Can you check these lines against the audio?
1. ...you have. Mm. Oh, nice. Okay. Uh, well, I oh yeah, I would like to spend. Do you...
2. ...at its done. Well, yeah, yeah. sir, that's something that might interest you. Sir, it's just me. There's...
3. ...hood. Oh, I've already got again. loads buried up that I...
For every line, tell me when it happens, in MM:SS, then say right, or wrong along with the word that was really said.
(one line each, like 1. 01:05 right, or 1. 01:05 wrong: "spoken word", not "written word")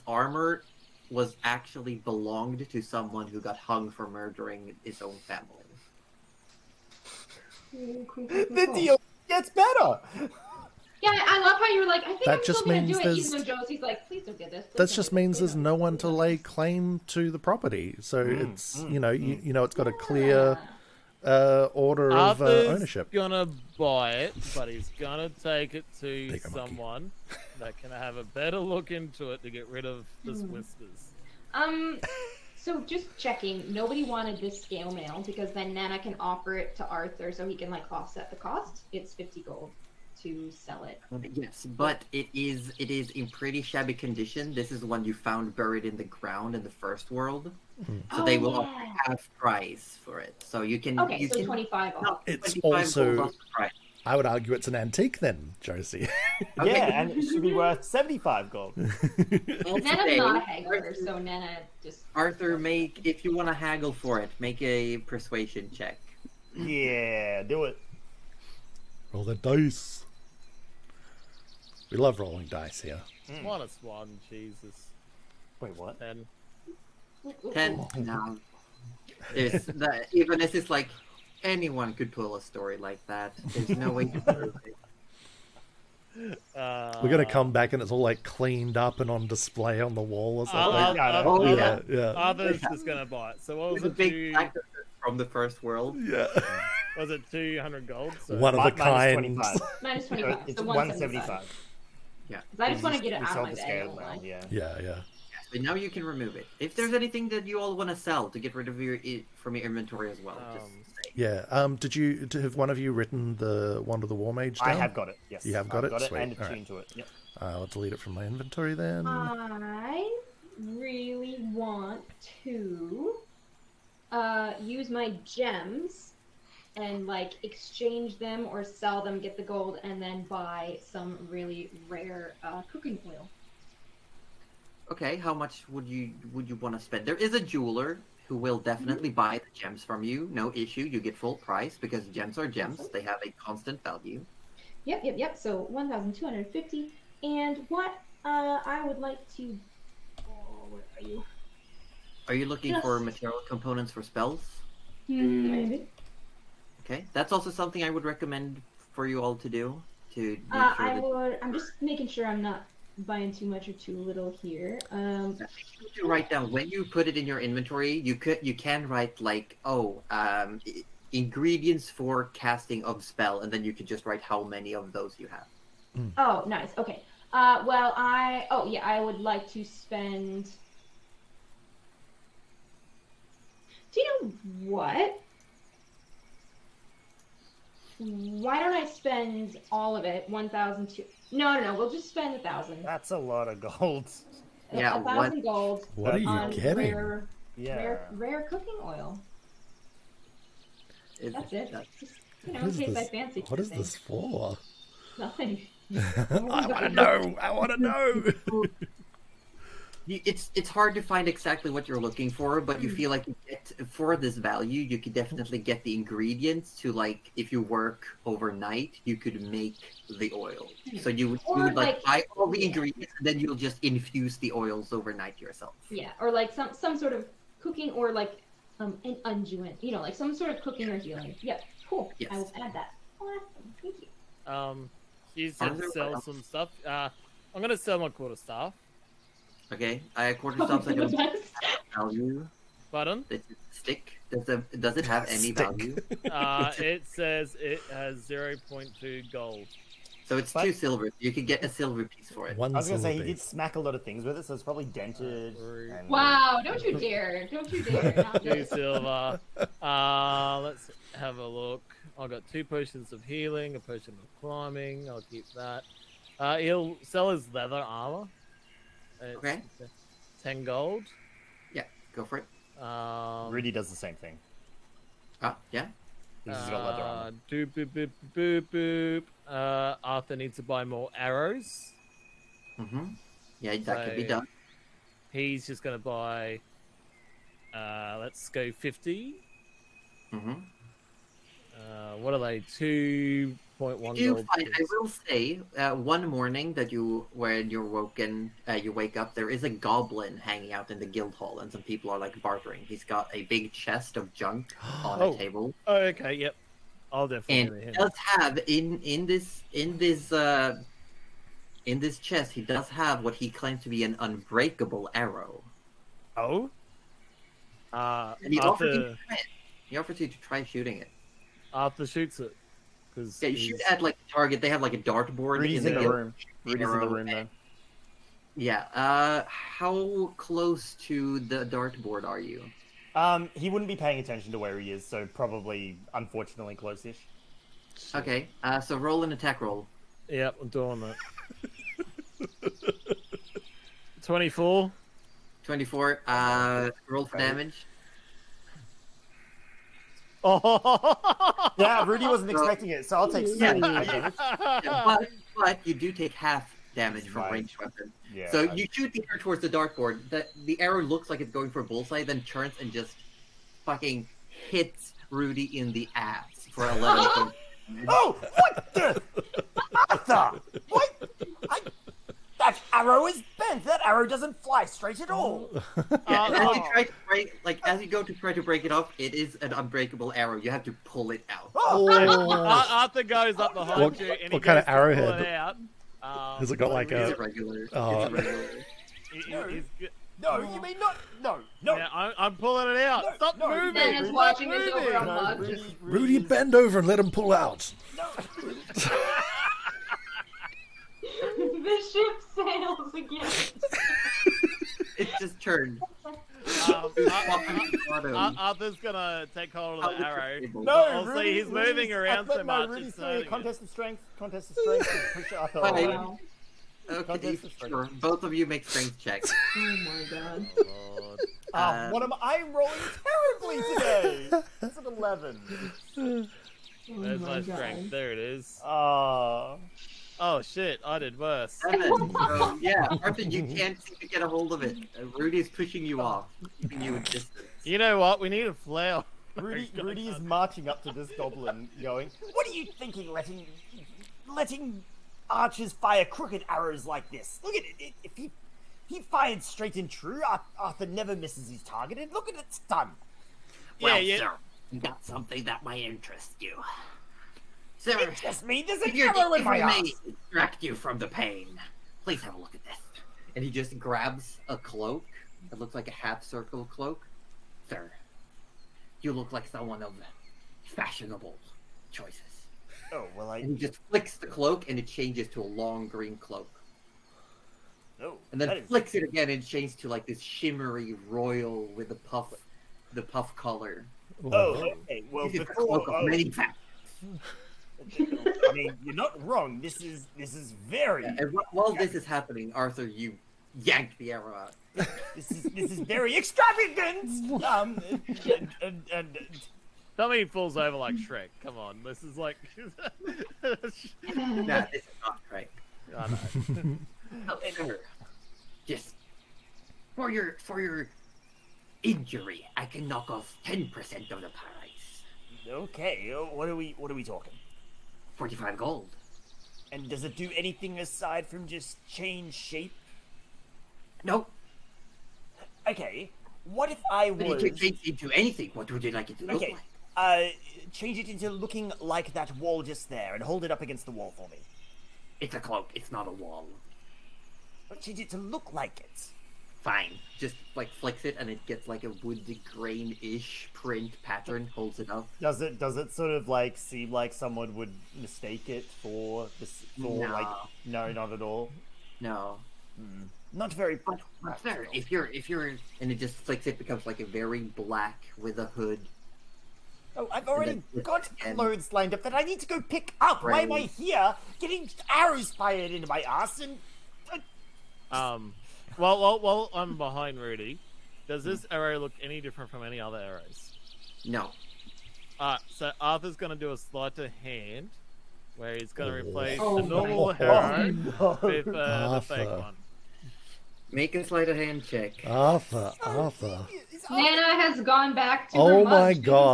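1. 02:55 right
2. 07:32 right
3. 09:18 wrong: "lined", not "buried".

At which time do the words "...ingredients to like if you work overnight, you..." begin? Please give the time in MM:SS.
03:35.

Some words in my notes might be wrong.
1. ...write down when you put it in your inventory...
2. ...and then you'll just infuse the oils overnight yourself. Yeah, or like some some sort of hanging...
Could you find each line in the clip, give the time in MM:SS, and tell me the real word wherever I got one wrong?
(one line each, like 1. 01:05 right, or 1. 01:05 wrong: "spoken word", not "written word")
1. 02:46 right
2. 03:43 wrong: "cooking", not "hanging".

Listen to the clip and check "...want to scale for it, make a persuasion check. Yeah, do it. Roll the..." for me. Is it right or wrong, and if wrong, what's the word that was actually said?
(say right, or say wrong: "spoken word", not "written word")
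wrong: "haggle", not "scale".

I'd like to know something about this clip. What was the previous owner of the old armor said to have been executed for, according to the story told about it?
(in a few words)
Murdering his own family.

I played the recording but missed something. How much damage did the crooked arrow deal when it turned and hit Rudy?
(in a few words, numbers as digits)
11.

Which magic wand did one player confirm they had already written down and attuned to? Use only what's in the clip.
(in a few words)
Wand of the war mage.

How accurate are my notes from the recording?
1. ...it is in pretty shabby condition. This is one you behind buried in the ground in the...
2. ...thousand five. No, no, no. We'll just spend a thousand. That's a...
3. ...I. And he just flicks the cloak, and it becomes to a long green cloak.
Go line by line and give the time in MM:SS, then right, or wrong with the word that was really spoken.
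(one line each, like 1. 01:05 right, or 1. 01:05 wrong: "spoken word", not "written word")
1. 00:42 wrong: "found", not "behind"
2. 03:10 wrong: "two", not "five"
3. 07:53 wrong: "changes", not "becomes".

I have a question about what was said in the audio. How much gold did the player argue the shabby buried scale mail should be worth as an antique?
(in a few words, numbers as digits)
75 gold.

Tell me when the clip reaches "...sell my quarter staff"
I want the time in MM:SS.
03:57.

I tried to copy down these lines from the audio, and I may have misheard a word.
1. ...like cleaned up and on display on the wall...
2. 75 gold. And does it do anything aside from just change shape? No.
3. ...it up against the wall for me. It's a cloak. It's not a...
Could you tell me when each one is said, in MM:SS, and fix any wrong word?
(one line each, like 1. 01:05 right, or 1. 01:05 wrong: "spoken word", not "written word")
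1. 01:28 right
2. 08:38 wrong: "45", not "75"
3. 08:53 right.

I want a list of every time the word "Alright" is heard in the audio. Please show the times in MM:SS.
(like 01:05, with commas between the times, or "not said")
09:35.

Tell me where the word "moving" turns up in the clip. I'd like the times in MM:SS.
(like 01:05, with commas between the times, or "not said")
06:33, 06:51.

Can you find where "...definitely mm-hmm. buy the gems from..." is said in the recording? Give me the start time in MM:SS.
02:18.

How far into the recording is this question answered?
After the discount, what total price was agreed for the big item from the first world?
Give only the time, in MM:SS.
01:40.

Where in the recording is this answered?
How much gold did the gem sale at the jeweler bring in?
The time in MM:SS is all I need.
02:25.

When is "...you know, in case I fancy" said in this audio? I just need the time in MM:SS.
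03:22.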